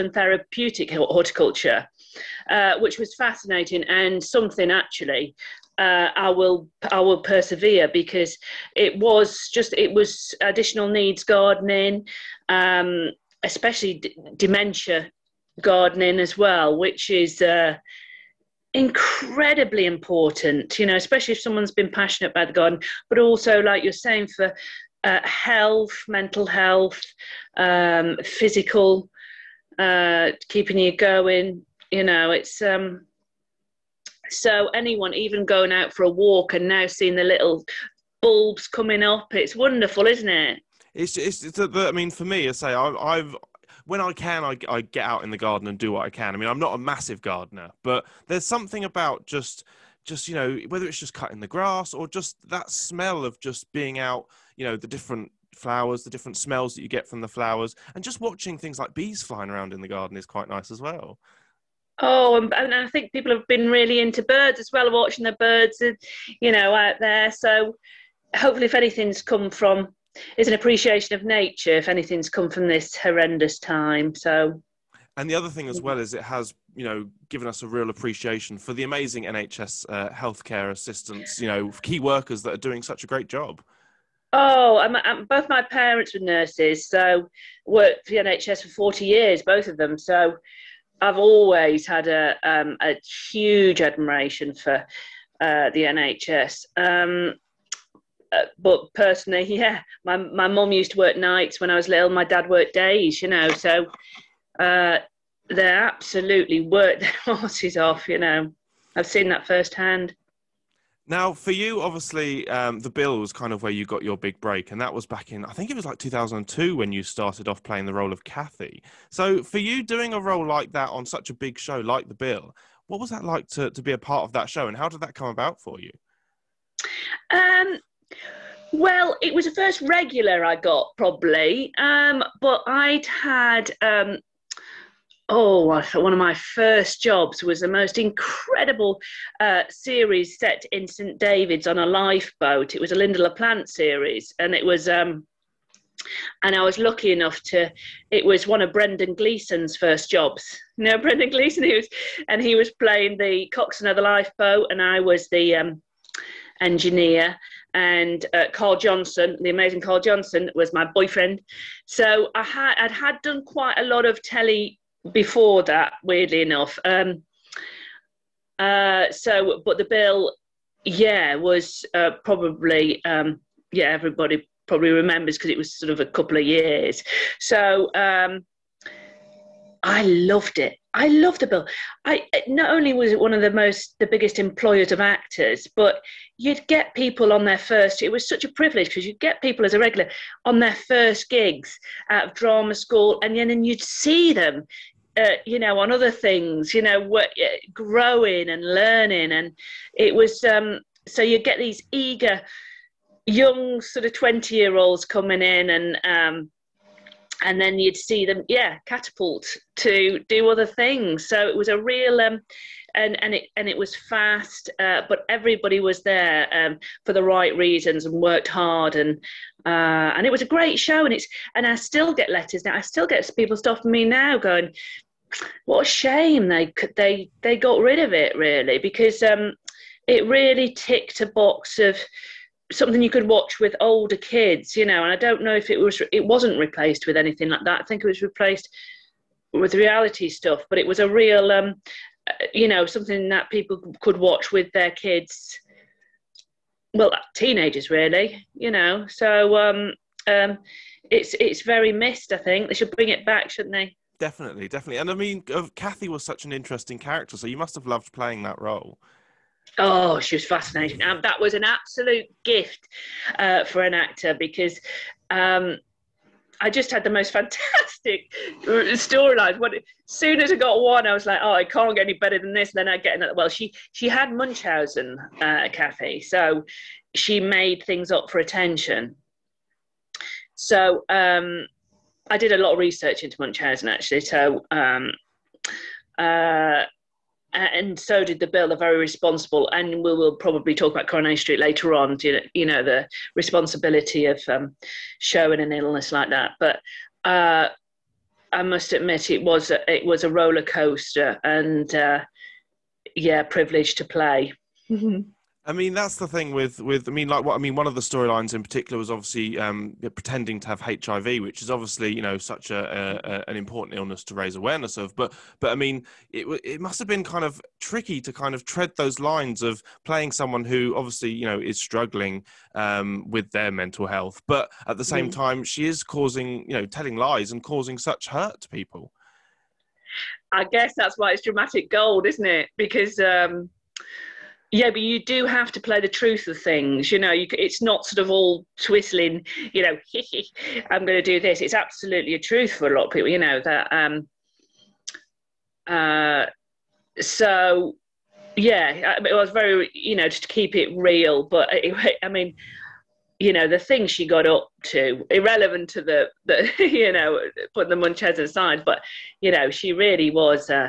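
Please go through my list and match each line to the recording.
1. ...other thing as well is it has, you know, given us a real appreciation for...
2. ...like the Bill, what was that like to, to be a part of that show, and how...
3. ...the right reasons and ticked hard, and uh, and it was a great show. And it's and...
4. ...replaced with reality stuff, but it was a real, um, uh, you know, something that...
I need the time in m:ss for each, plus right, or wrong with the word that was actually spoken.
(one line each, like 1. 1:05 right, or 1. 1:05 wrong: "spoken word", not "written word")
1. 1:15 right
2. 2:01 right
3. 3:37 wrong: "worked", not "ticked"
4. 3:58 right.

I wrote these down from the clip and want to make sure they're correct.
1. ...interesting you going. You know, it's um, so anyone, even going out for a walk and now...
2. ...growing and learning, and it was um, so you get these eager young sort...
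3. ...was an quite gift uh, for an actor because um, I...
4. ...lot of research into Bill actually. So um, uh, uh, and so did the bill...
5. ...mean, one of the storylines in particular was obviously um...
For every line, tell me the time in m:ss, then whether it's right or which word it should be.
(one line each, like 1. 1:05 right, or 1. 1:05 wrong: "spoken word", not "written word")
1. 0:30 wrong: "keeping", not "interesting"
2. 3:17 right
3. 4:21 wrong: "absolute", not "quite"
4. 4:42 wrong: "Munchausen", not "Bill"
5. 5:07 right.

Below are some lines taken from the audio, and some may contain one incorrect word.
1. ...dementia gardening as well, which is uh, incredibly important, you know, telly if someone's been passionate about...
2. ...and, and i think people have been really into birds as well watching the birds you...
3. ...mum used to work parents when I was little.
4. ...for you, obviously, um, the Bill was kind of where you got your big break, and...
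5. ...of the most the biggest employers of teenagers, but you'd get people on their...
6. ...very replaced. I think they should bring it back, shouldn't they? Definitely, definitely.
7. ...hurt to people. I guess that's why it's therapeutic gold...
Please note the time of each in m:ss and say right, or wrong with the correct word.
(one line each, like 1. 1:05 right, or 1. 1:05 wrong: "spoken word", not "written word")
1. 0:14 wrong: "especially", not "telly"
2. 1:02 right
3. 1:40 wrong: "nights", not "parents"
4. 1:51 right
5. 3:03 wrong: "actors", not "teenagers"
6. 4:11 wrong: "missed", not "replaced"
7. 5:28 wrong: "dramatic", not "therapeutic".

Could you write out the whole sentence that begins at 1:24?
Oh, I'm, I'm, both my parents were nurses, so worked for the NHS for 40 years, both of them.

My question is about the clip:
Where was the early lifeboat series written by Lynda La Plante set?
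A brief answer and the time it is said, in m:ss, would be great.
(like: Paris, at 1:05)
St. David's, at 2:20.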